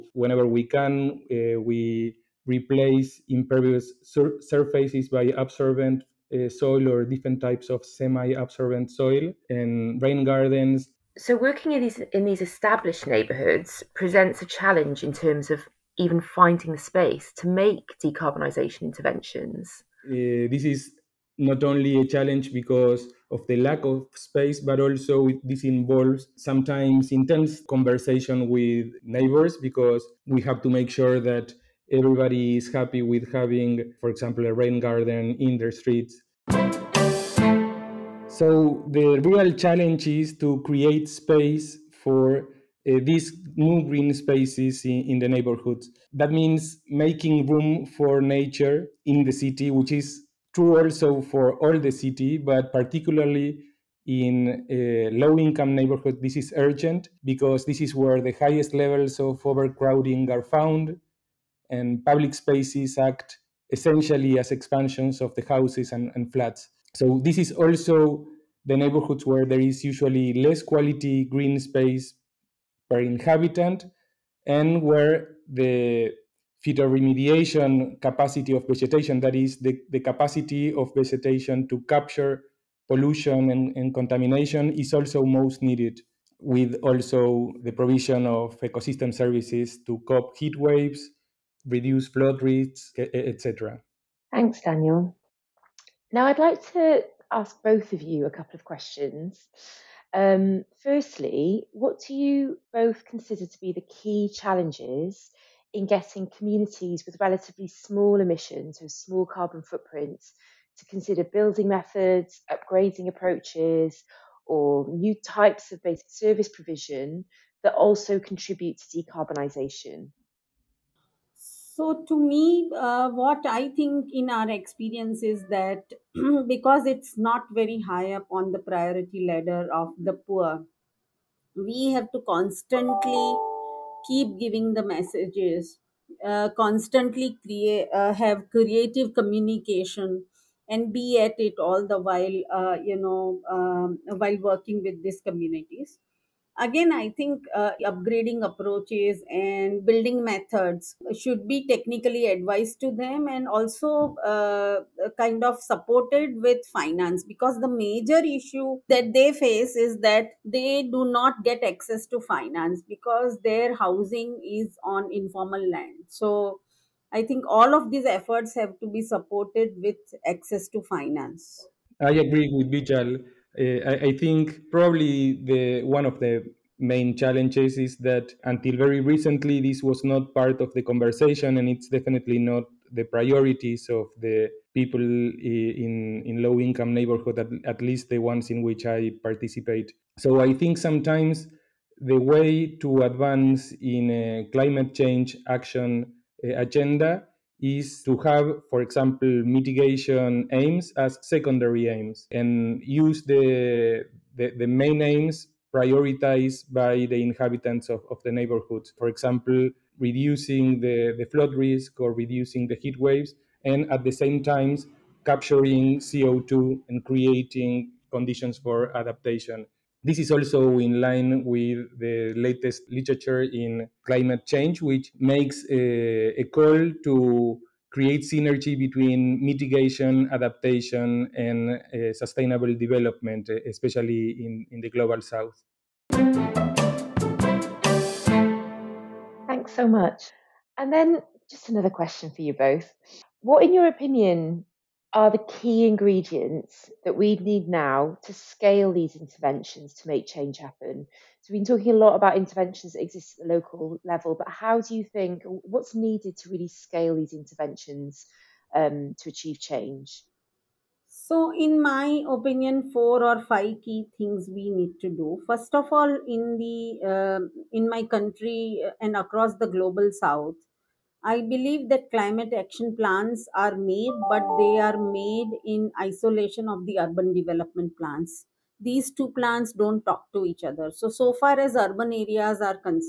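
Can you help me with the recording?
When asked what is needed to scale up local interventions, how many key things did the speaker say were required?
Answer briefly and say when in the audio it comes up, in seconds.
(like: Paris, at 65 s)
4 or 5, at 262 s.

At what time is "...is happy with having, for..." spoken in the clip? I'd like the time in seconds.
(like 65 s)
32 s.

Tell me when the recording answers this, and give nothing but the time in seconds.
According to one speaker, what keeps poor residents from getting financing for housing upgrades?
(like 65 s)
165 s.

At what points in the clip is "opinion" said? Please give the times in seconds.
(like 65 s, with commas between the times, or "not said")
243 s, 262 s.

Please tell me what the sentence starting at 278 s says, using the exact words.
These two plans don't talk to each other.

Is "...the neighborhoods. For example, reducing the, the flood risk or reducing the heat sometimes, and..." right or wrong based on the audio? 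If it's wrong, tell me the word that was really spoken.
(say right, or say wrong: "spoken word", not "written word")
wrong: "waves", not "sometimes".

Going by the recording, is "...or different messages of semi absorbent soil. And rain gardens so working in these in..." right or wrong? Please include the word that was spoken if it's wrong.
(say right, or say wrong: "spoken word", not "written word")
wrong: "types", not "messages".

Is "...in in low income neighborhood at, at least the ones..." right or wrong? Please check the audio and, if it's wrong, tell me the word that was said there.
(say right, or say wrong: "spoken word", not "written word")
right.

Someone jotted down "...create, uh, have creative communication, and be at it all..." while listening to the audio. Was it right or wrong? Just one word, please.
right.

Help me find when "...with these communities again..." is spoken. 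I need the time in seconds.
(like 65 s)
144 s.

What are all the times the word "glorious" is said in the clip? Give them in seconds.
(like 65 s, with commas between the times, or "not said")
not said.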